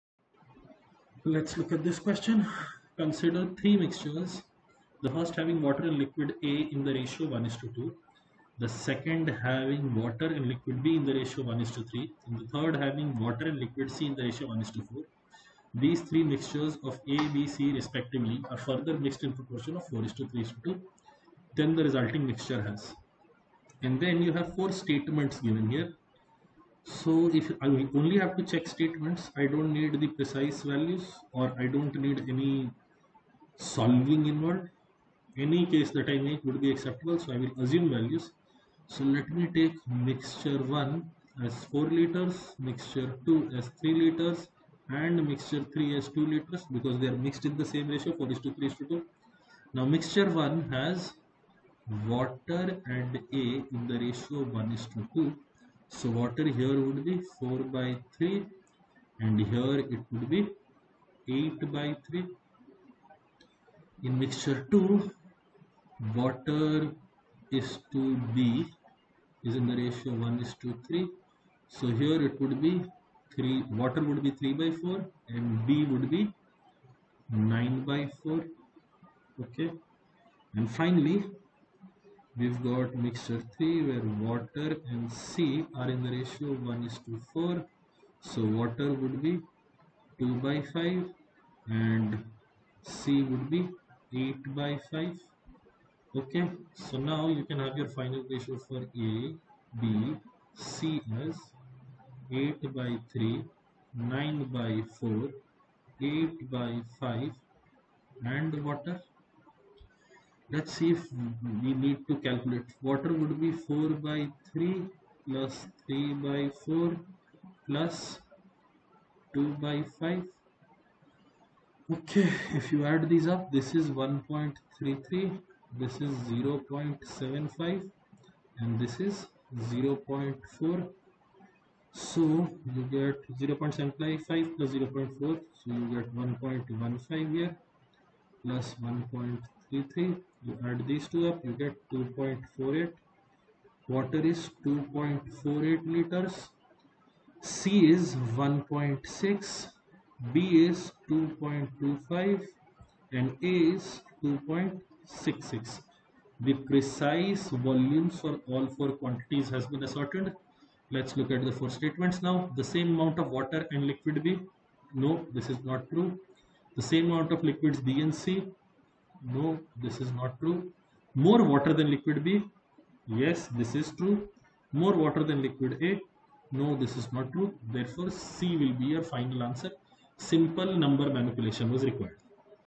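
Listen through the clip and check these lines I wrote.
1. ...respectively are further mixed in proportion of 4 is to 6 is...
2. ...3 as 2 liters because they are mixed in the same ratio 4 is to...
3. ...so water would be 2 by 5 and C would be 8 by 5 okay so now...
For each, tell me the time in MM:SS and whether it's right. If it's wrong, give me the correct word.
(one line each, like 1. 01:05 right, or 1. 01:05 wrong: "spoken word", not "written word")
1. 00:17 wrong: "3", not "6"
2. 00:45 right
3. 01:28 right.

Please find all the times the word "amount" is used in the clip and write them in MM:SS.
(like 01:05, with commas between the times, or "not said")
02:42, 02:47.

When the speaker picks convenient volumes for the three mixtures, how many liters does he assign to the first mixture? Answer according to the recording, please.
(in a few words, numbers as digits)
4 liters.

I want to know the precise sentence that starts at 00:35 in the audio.
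Any case that I make would be acceptable, so I will assume values.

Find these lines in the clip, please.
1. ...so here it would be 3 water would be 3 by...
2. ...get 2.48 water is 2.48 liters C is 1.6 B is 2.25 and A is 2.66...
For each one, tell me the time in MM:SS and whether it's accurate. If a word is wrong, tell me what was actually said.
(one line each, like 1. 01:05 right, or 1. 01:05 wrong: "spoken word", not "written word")
1. 01:11 right
2. 02:21 right.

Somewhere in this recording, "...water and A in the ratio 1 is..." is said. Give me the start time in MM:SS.
00:52.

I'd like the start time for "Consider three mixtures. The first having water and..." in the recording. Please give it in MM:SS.
00:02.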